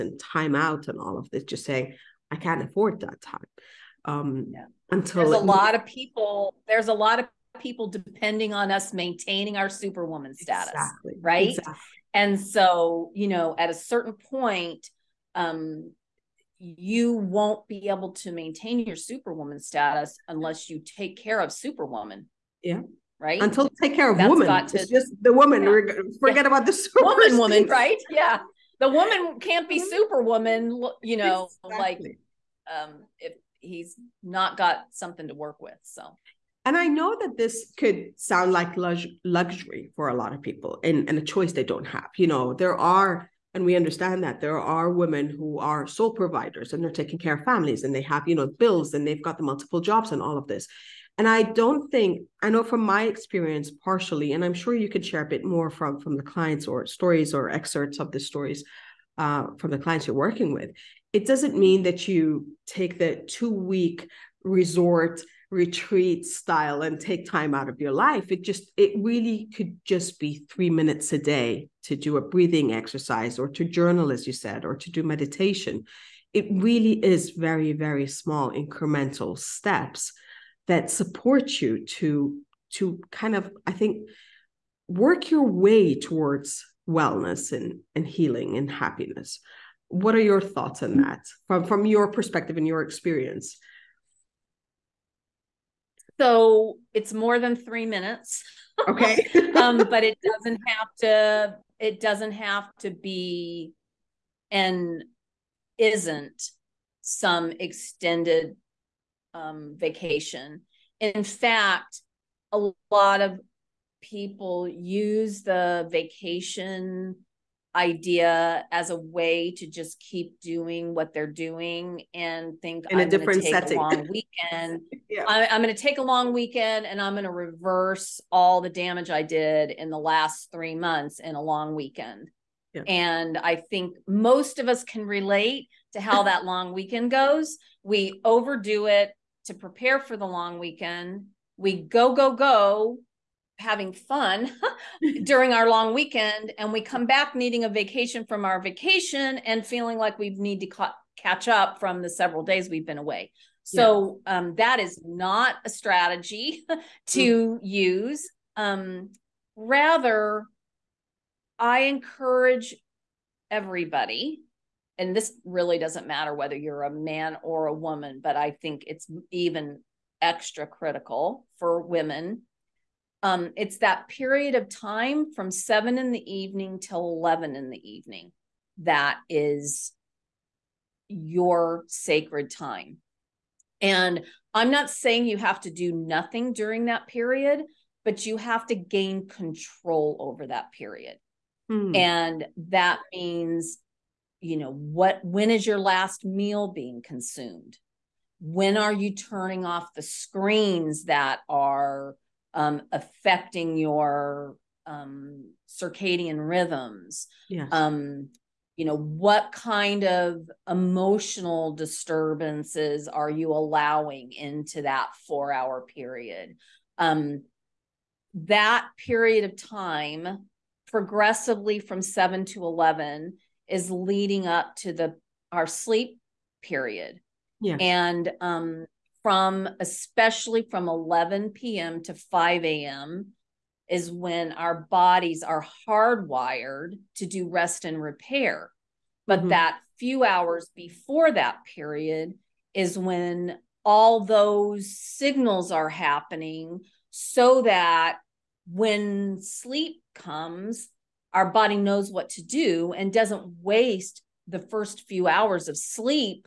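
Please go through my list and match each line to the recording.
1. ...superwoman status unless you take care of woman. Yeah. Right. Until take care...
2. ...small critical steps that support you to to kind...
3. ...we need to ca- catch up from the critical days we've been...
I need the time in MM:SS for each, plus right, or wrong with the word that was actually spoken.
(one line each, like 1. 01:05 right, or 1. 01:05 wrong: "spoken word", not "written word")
1. 00:18 wrong: "superwoman", not "woman"
2. 01:18 wrong: "incremental", not "critical"
3. 02:30 wrong: "several", not "critical".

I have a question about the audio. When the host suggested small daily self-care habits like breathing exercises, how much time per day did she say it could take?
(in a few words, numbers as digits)
3 minutes.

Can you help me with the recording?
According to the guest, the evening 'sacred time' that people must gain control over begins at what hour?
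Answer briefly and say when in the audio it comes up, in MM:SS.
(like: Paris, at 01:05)
7 in the evening, at 02:55.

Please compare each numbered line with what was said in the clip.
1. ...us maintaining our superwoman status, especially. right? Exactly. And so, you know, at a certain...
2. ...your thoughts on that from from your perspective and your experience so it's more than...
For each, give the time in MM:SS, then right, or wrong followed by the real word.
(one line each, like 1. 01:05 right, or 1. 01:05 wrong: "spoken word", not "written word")
1. 00:08 wrong: "exactly", not "especially"
2. 01:30 right.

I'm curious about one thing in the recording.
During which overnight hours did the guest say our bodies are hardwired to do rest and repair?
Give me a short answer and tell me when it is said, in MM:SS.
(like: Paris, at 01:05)
11 p.m. to 5 a.m., at 03:50.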